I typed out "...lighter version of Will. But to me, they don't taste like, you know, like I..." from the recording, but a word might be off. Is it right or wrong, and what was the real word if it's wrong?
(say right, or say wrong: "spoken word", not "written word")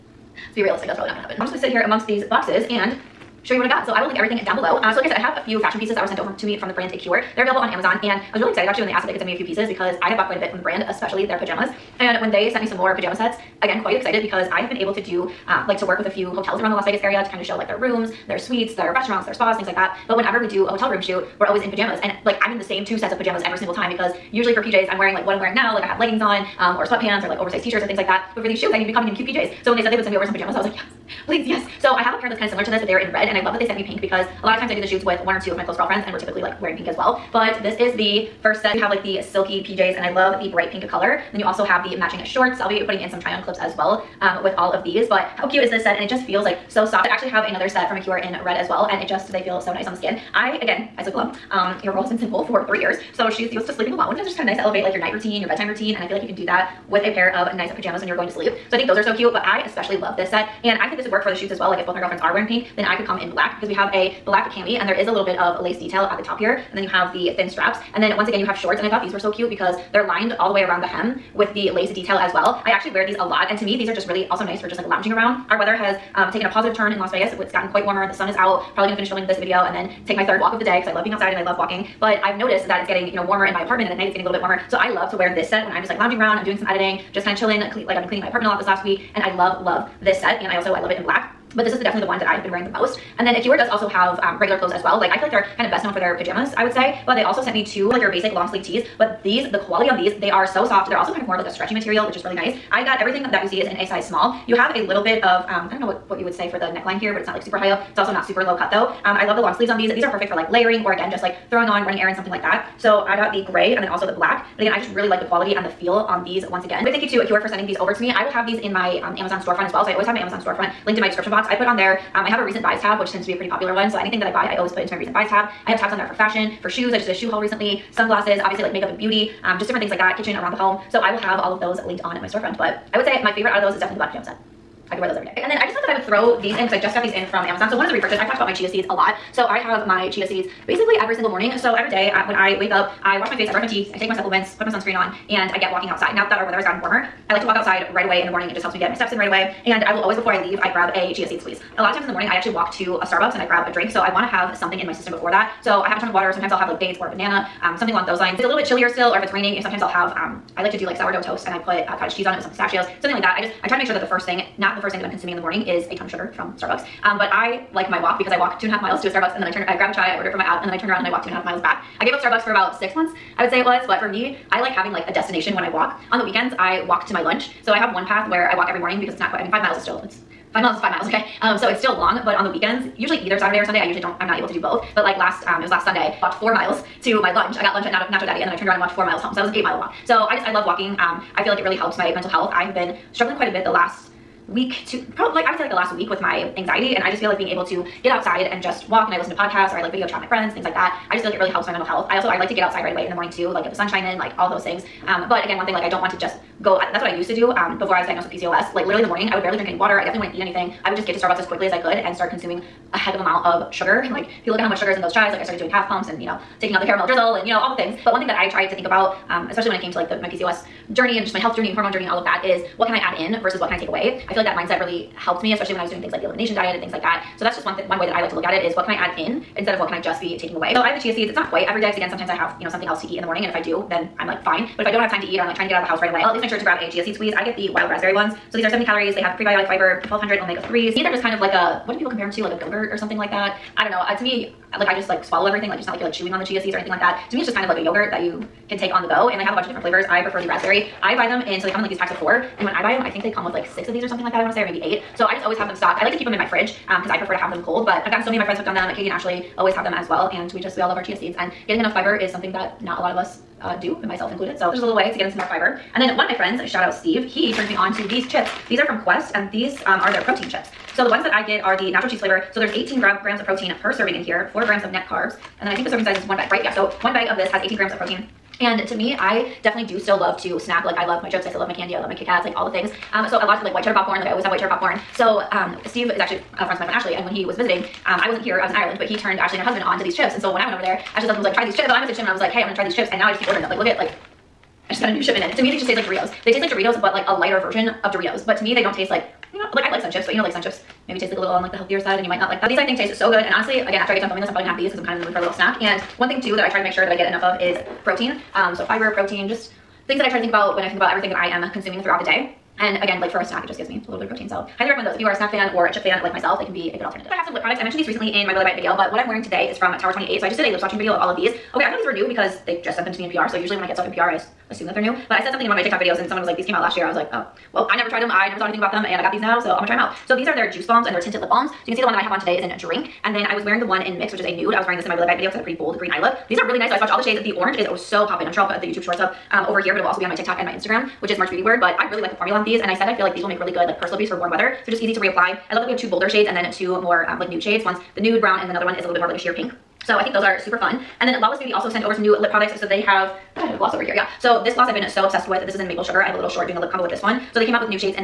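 wrong: "Doritos", not "Will".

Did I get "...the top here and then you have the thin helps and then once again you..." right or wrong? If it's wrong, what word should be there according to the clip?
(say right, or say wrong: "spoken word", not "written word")
wrong: "straps", not "helps".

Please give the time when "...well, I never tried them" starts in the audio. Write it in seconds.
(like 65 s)
327 s.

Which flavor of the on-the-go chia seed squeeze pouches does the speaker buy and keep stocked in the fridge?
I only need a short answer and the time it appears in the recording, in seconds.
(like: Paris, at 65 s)
Wild raspberry, at 237 s.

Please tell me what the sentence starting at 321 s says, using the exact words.
Okay, I thought these were new because they just sent them to me in PR.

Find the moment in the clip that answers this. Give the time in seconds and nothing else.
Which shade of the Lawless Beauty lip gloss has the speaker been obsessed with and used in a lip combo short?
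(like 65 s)
355 s.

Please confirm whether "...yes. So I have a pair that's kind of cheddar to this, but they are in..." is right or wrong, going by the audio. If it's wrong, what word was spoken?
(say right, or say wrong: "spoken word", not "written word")
wrong: "similar", not "cheddar".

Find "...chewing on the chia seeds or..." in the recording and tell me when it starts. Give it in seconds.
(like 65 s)
246 s.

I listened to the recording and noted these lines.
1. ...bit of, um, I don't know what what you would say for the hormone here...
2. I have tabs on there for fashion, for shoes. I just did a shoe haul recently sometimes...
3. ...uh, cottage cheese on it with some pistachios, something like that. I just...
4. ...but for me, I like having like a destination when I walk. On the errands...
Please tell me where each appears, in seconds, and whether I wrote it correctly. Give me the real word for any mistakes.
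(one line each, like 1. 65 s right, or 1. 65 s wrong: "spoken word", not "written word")
1. 105 s wrong: "neckline", not "hormone"
2. 125 s wrong: "sunglasses", not "sometimes"
3. 161 s right
4. 173 s wrong: "weekends", not "errands".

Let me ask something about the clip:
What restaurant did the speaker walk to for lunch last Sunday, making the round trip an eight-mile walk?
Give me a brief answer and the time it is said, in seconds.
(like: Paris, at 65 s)
Nacho Daddy, at 187 s.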